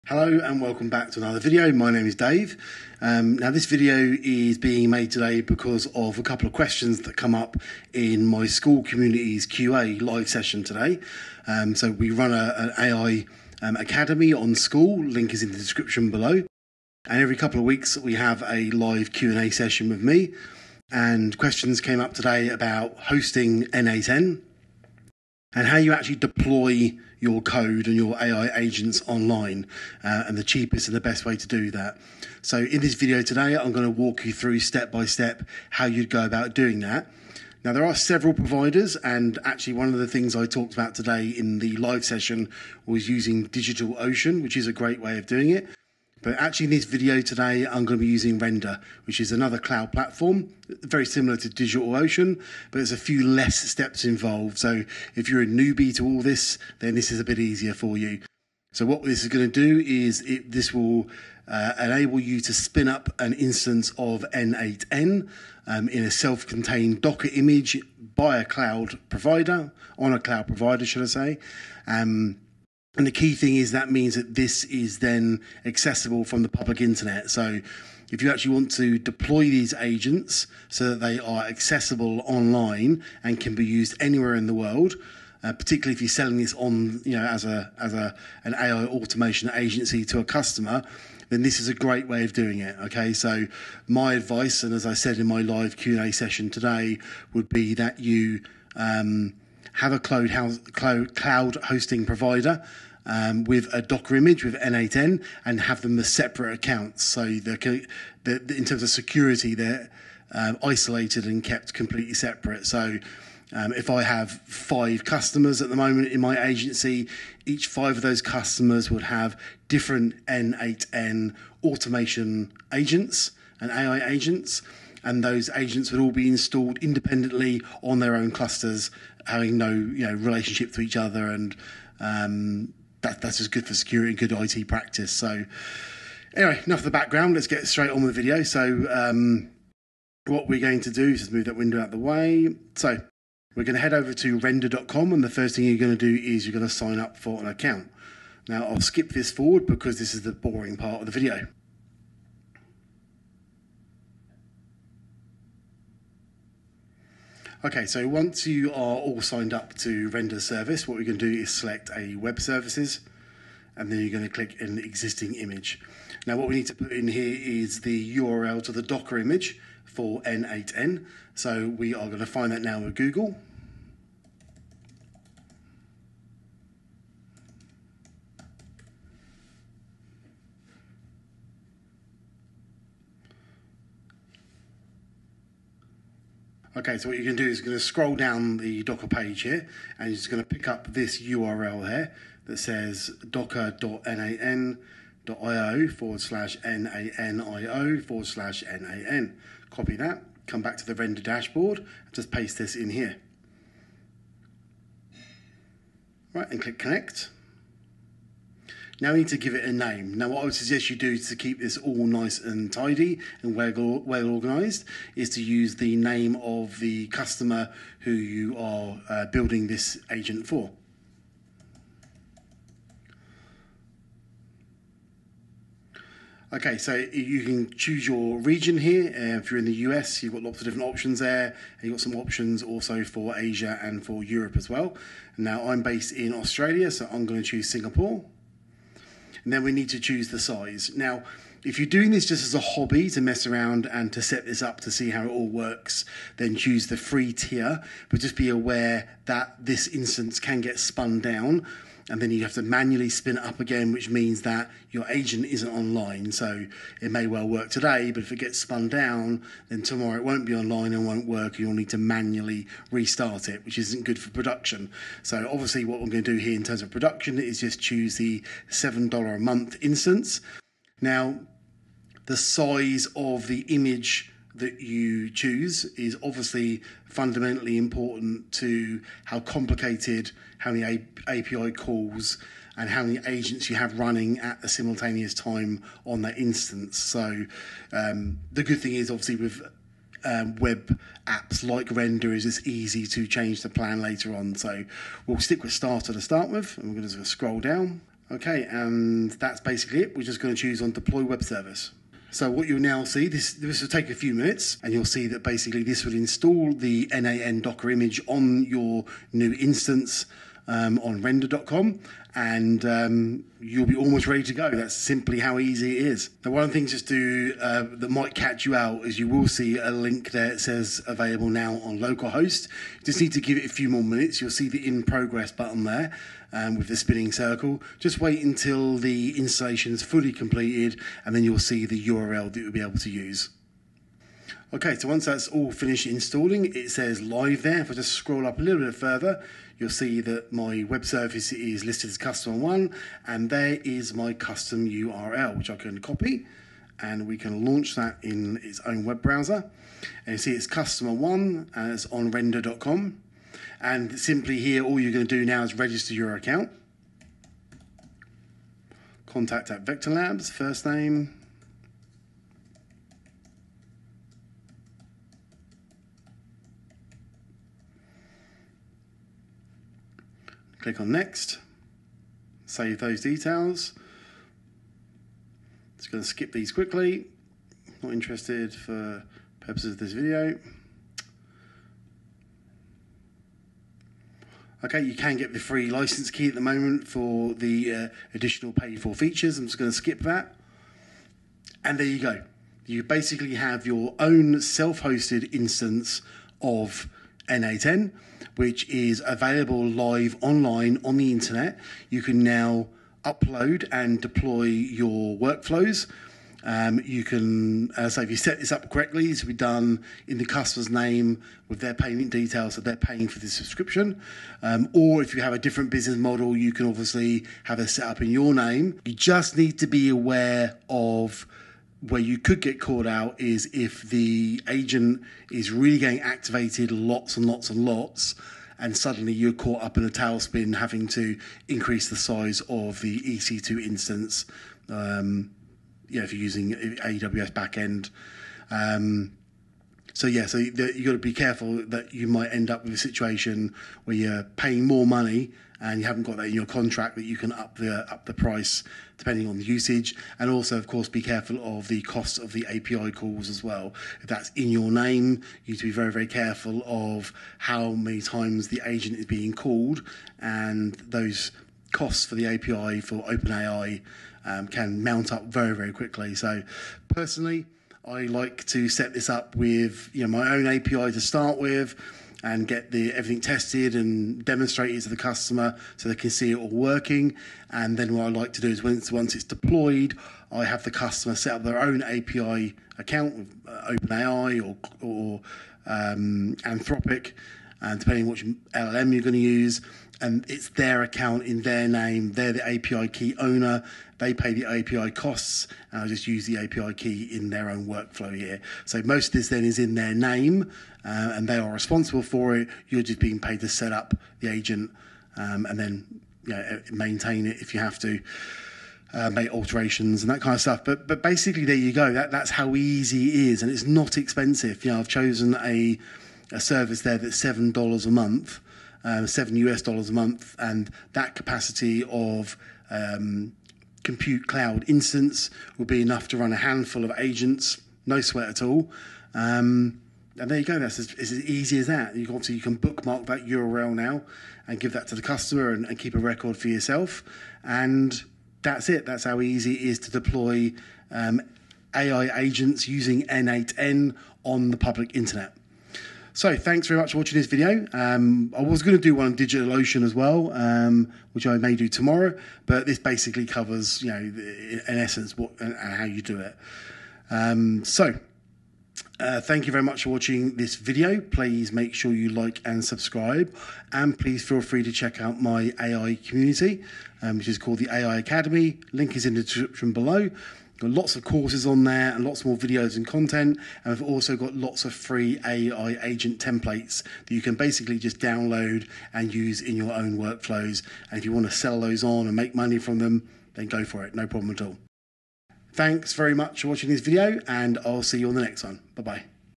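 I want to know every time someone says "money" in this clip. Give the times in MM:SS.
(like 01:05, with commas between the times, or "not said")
07:25, 09:42.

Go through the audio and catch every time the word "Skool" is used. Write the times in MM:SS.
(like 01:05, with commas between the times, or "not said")
00:08, 00:14.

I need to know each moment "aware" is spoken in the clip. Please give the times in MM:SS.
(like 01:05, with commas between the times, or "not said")
04:08, 07:00.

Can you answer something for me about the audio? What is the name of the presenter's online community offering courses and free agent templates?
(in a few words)
AI Academy.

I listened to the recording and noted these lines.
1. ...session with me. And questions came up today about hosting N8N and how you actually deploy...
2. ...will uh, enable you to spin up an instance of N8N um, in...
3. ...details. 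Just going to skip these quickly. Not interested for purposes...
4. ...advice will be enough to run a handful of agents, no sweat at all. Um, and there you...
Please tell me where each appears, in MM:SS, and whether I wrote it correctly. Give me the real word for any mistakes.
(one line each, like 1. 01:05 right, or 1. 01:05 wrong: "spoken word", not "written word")
1. 00:19 right
2. 01:00 right
3. 06:13 right
4. 08:44 wrong: "instance", not "advice".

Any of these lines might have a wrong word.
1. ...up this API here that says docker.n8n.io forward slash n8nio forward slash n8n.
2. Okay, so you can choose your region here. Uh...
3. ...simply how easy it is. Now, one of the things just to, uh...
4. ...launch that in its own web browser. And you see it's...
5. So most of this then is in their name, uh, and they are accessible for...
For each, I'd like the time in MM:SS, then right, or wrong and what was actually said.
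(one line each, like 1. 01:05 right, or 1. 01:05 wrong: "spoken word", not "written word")
1. 03:10 wrong: "URL", not "API"
2. 03:46 right
3. 05:14 right
4. 05:47 right
5. 08:18 wrong: "responsible", not "accessible".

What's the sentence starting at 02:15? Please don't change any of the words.
So anyway, enough of the background.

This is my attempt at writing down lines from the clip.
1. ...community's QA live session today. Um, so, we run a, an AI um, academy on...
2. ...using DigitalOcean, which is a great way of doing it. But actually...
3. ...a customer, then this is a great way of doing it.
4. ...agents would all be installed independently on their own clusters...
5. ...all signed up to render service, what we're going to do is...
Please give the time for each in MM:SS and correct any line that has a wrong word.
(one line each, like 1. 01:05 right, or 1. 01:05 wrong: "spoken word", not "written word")
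1. 00:08 right
2. 00:43 right
3. 01:30 right
4. 02:05 right
5. 02:39 right.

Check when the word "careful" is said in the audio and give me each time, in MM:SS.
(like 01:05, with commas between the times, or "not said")
07:21, 07:31, 07:36.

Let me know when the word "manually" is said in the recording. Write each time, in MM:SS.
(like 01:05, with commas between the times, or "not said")
04:12, 04:21.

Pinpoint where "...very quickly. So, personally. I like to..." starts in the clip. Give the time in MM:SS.
07:45.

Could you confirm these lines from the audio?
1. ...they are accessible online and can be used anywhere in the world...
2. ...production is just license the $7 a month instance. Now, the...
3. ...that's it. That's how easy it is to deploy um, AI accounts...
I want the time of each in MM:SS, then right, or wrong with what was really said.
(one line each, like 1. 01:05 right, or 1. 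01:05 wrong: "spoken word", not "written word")
1. 01:20 right
2. 04:26 wrong: "choose", not "license"
3. 08:58 wrong: "agents", not "accounts".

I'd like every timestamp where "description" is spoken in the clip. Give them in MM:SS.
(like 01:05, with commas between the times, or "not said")
00:15, 09:29.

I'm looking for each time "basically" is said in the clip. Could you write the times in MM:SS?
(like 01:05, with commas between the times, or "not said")
04:59, 05:05, 06:33, 08:31, 09:12, 09:37.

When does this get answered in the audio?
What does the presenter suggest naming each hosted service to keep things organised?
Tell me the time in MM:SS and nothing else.
03:35.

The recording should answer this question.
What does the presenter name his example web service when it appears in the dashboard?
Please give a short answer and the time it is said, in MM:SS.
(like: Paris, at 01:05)
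custom one, at 05:42.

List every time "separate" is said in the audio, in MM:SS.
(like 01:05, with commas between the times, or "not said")
01:46, 01:52.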